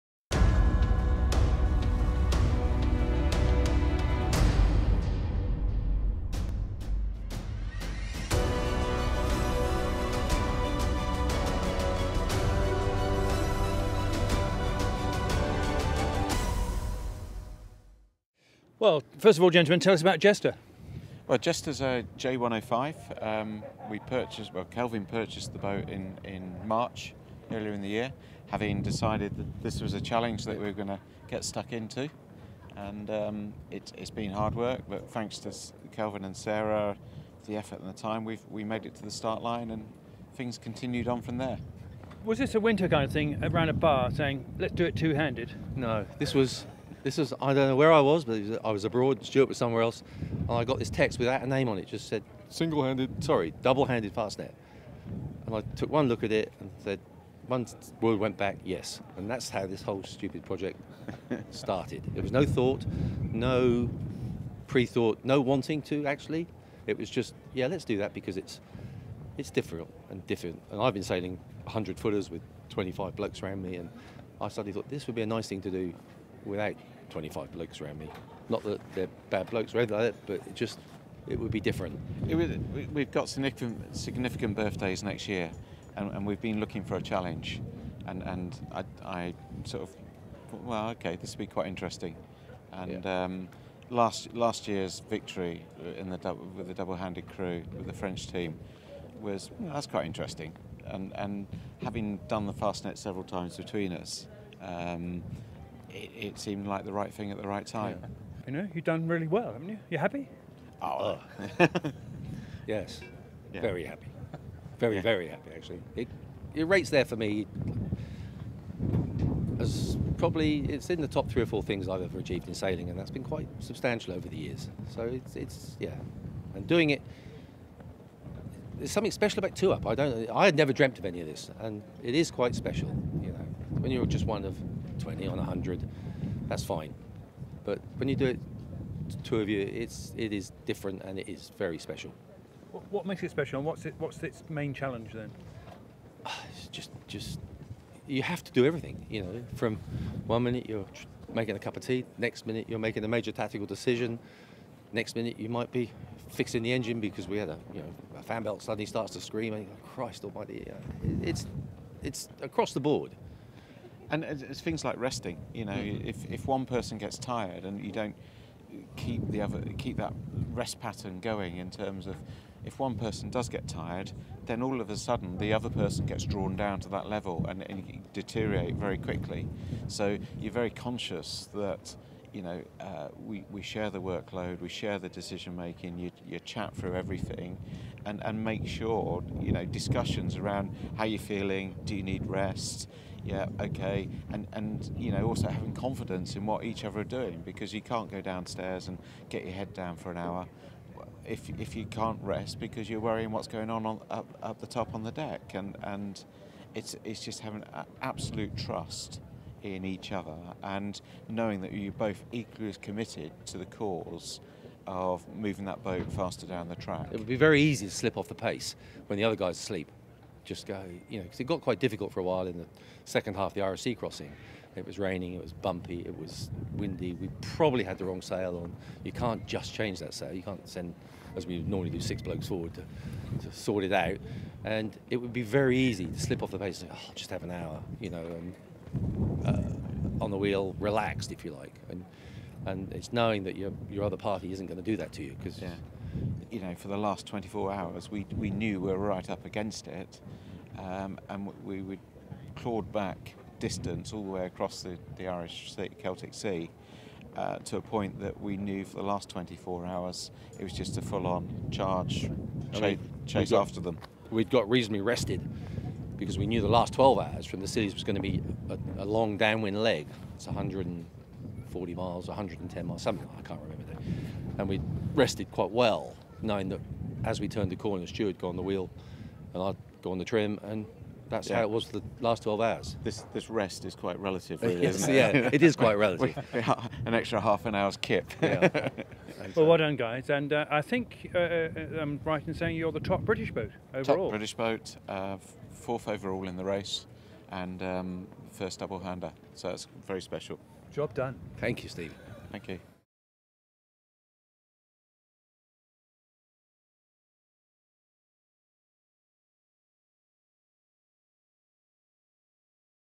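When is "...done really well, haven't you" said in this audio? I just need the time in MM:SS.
01:48.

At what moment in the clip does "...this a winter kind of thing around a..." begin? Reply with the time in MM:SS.
00:42.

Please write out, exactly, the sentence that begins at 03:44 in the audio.
It was raining, it was bumpy, it was windy.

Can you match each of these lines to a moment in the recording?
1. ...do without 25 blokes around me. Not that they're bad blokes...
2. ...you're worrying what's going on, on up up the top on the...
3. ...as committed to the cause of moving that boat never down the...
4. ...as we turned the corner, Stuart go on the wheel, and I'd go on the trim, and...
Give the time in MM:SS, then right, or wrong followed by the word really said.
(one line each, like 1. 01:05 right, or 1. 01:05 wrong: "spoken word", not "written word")
1. 01:15 right
2. 03:22 right
3. 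03:32 wrong: "faster", not "never"
4. 04:37 right.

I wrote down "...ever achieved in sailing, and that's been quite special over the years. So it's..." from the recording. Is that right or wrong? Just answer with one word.
wrong.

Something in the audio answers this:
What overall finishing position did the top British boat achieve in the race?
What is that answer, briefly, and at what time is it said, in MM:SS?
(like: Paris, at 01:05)
4th, at 04:55.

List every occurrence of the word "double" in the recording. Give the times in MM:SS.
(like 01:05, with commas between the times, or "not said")
00:53, 01:36, 04:58.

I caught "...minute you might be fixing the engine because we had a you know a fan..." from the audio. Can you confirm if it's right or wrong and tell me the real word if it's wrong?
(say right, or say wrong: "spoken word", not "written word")
right.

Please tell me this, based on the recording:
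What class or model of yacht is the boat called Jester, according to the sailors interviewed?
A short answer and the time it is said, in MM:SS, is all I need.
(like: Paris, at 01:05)
J105, at 00:22.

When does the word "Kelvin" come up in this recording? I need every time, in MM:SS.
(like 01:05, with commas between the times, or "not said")
00:24, 00:35.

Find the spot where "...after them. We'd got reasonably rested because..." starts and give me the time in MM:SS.
04:23.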